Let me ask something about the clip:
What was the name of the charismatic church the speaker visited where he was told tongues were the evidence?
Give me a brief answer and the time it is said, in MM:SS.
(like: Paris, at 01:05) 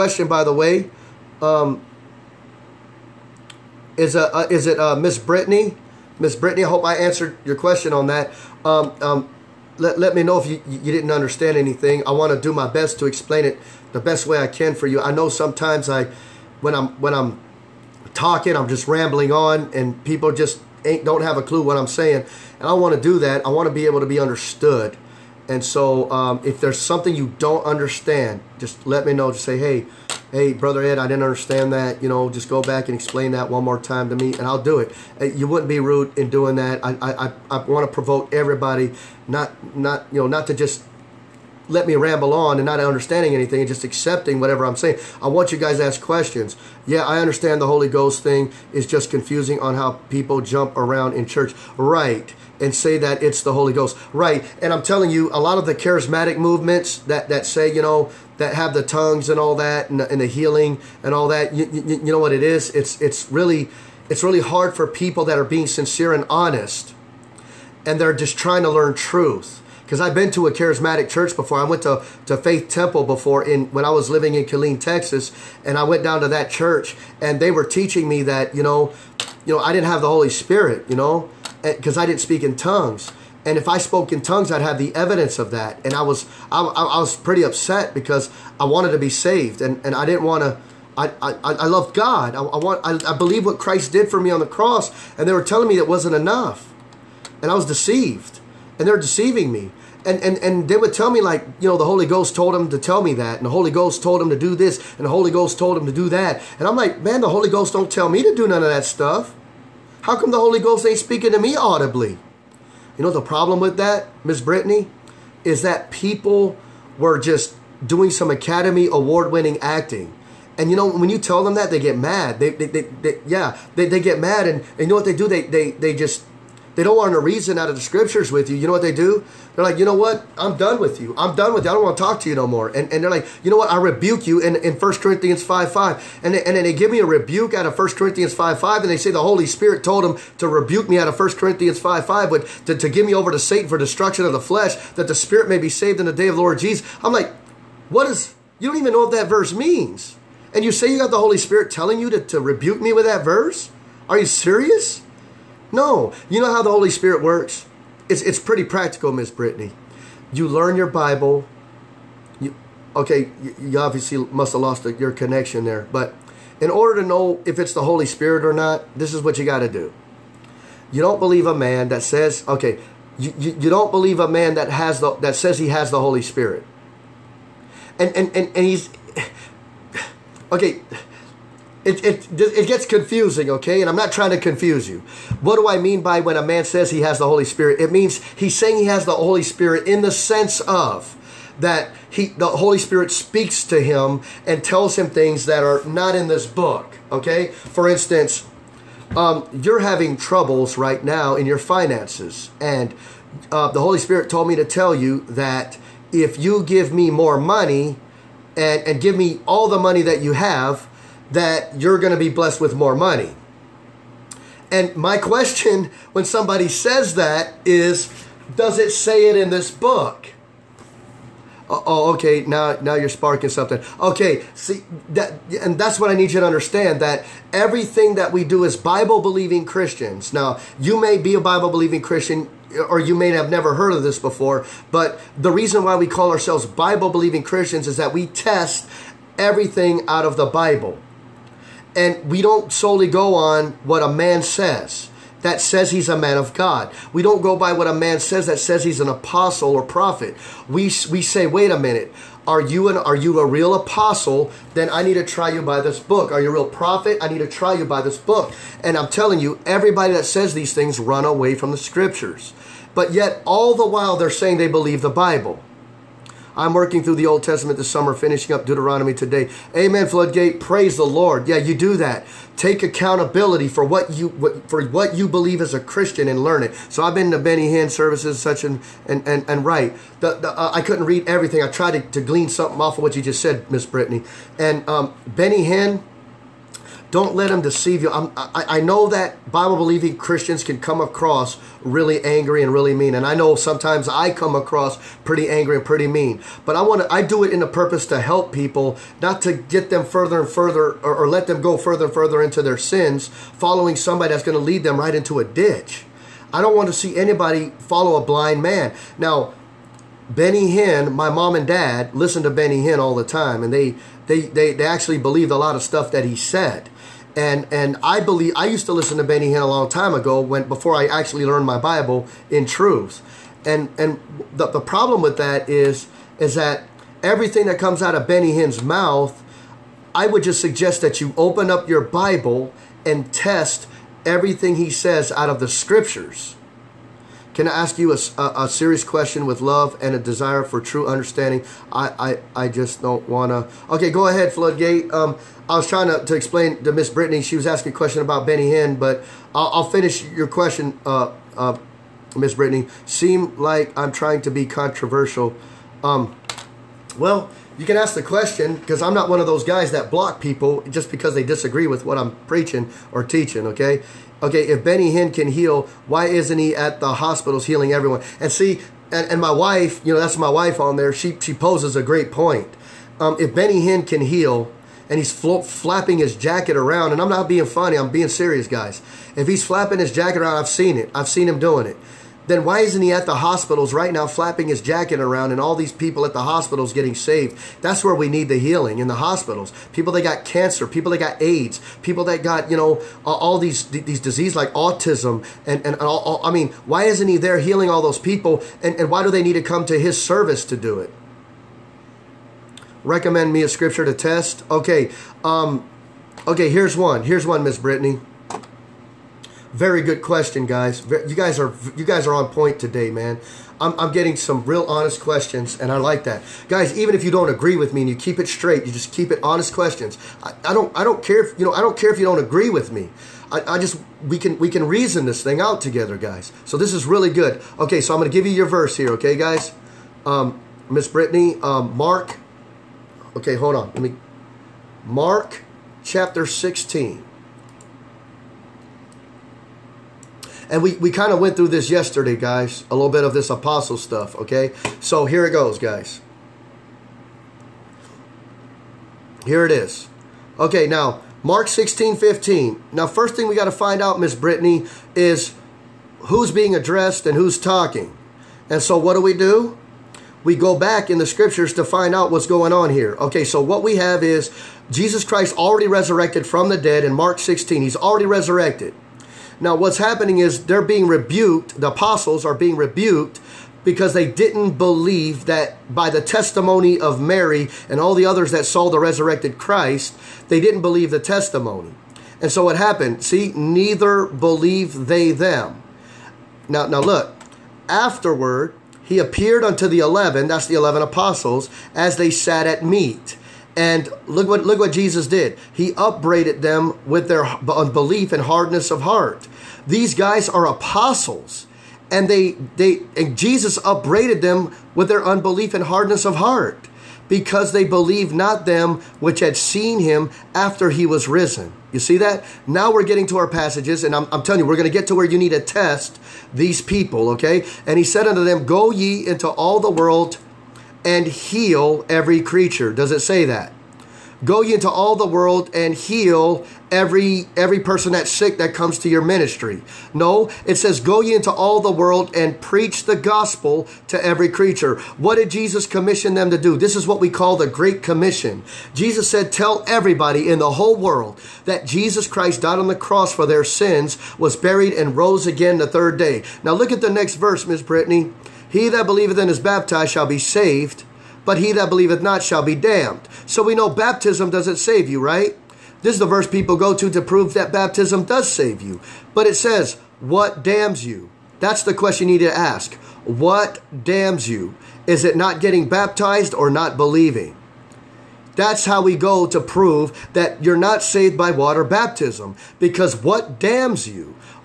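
Faith Temple, at 01:12.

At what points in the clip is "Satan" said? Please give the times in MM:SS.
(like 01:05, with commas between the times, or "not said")
02:23.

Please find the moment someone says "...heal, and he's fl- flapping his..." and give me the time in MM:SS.
06:14.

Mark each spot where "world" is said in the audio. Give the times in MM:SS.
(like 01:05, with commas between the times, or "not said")
08:39, 08:45, 08:51, 09:00.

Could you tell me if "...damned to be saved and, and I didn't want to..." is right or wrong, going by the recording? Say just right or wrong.
wrong.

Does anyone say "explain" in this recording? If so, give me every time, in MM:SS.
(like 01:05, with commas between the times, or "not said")
00:13, 00:32, 05:46.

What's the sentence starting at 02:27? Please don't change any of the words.
I'm like, what is, you don't even know what that verse means.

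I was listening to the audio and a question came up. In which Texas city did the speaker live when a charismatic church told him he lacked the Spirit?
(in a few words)
Killeen.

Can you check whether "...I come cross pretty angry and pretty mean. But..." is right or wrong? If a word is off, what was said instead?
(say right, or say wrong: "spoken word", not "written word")
wrong: "across", not "cross".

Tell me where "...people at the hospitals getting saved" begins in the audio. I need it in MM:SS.
06:25.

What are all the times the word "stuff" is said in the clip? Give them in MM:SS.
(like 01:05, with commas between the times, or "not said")
01:48, 05:15, 07:23.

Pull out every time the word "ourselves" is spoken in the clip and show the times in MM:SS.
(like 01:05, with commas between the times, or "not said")
03:56.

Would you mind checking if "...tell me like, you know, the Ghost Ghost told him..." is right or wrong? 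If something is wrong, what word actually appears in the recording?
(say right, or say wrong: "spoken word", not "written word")
wrong: "Holy", not "Ghost".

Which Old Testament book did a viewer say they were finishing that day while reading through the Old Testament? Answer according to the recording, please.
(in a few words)
Deuteronomy.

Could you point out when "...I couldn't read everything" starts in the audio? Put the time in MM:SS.
04:40.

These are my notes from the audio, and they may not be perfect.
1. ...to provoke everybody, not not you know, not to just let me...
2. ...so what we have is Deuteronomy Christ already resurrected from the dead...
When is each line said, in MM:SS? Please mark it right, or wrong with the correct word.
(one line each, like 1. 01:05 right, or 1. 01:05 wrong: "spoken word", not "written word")
1. 00:37 right
2. 07:43 wrong: "Jesus", not "Deuteronomy".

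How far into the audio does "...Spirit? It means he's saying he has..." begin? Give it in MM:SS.
03:07.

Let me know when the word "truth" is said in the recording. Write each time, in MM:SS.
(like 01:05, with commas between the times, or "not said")
01:08, 05:22.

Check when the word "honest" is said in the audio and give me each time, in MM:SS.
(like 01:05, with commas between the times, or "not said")
01:06, 06:54, 06:59.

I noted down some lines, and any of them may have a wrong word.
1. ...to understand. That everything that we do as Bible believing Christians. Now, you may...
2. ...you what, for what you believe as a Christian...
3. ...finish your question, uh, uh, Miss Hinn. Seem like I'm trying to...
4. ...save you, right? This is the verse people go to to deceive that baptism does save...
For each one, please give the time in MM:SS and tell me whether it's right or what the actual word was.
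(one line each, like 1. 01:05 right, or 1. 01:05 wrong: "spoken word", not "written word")
1. 03:46 right
2. 04:34 right
3. 05:49 wrong: "Brittany", not "Hinn"
4. 09:14 wrong: "prove", not "deceive".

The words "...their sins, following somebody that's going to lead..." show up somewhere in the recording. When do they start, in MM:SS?
05:02.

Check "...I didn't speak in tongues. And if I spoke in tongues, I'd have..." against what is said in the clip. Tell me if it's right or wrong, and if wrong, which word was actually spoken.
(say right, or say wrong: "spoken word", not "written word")
right.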